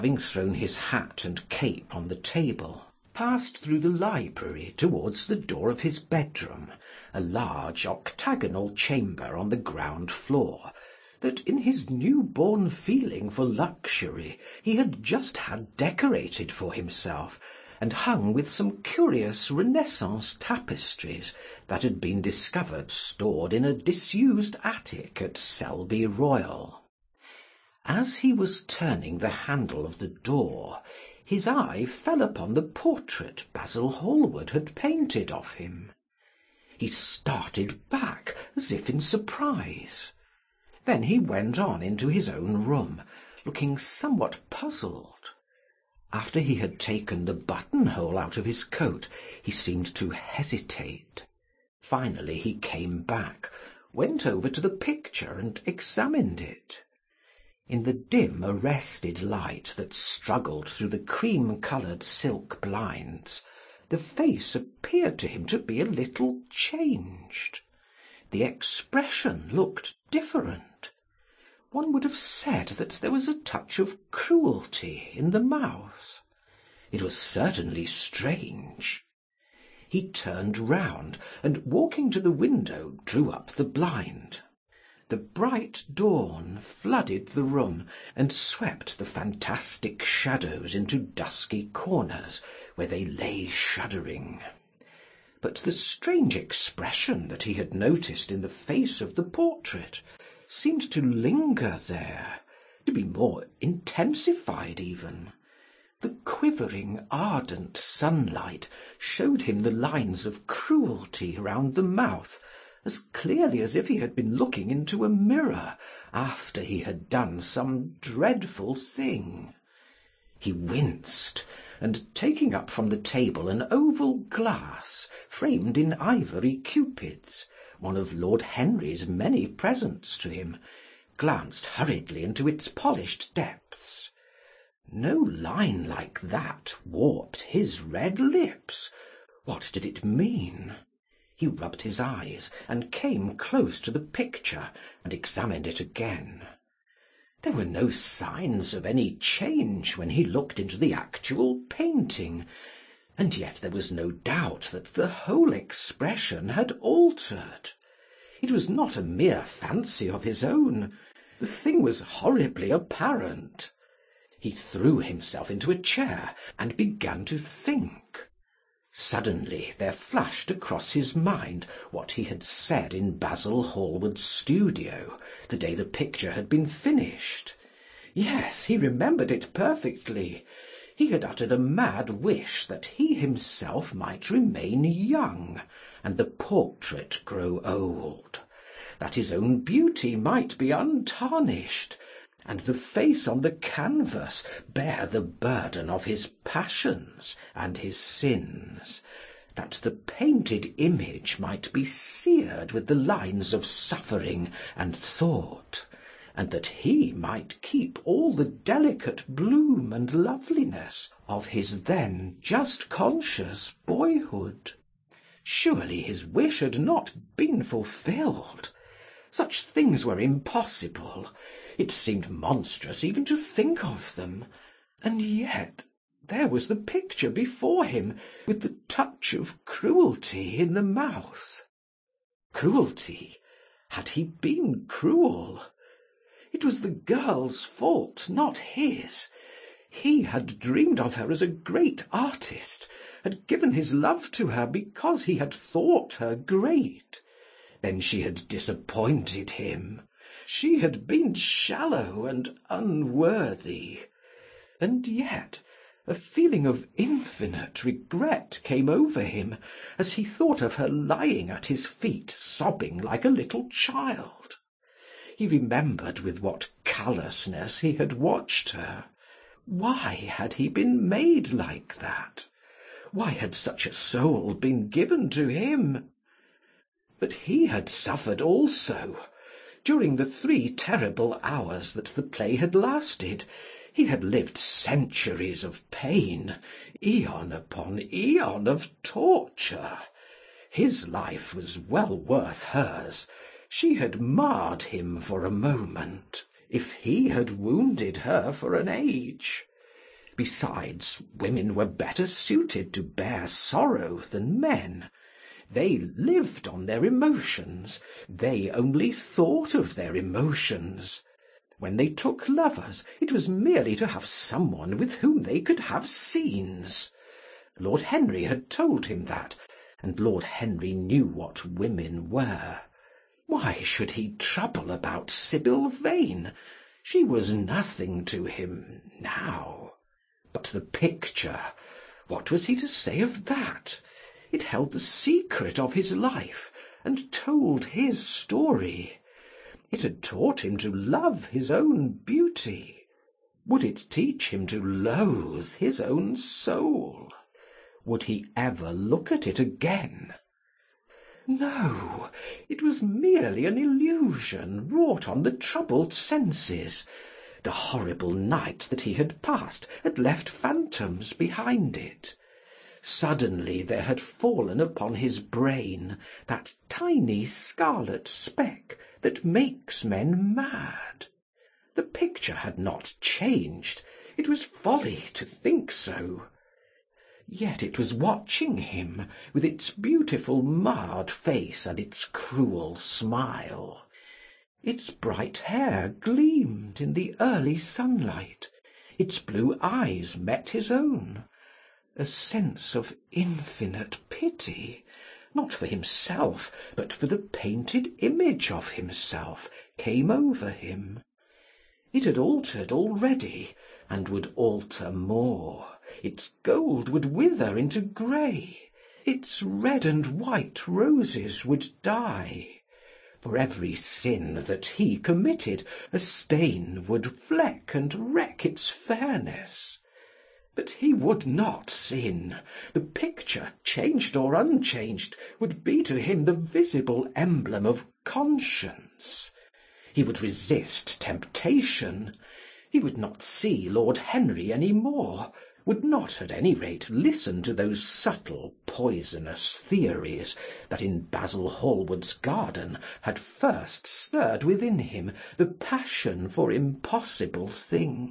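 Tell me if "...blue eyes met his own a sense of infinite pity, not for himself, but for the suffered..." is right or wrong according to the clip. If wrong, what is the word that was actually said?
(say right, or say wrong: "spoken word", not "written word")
wrong: "painted", not "suffered".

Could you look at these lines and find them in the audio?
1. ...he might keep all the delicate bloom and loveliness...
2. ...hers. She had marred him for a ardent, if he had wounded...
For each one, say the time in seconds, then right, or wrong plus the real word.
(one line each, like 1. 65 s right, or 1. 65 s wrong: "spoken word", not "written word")
1. 206 s right
2. 292 s wrong: "moment", not "ardent".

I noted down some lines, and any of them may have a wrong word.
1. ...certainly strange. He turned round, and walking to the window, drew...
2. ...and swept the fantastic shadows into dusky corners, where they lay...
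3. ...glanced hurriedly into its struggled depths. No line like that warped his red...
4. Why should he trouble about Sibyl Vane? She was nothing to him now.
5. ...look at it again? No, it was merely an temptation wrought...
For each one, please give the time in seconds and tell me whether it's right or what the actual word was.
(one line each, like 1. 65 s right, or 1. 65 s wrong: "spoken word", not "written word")
1. 77 s right
2. 88 s right
3. 131 s wrong: "polished", not "struggled"
4. 323 s right
5. 348 s wrong: "illusion", not "temptation".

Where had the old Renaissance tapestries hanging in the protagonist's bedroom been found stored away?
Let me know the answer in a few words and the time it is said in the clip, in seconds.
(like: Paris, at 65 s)
Selby Royal, at 25 s.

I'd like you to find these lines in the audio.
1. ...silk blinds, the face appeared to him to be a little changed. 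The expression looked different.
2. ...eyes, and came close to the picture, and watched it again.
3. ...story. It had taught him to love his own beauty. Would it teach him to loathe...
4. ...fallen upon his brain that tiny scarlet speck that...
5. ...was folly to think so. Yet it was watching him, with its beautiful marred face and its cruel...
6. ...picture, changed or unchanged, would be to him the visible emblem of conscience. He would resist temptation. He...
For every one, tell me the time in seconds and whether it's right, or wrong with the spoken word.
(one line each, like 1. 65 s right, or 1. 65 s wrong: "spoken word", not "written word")
1. 62 s right
2. 141 s wrong: "examined", not "watched"
3. 338 s right
4. 364 s right
5. 374 s right
6. 423 s right.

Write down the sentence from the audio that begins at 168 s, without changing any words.
Suddenly there flashed across his mind what he had said in Basil Hallward's studio the day the picture had been finished.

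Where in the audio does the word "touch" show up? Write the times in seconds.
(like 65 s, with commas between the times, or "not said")
73 s, 228 s.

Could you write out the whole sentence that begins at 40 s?
Then he went on into his own room, looking somewhat puzzled.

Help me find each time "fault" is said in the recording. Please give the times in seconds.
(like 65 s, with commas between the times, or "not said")
237 s.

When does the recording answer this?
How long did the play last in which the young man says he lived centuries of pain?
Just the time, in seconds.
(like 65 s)
280 s.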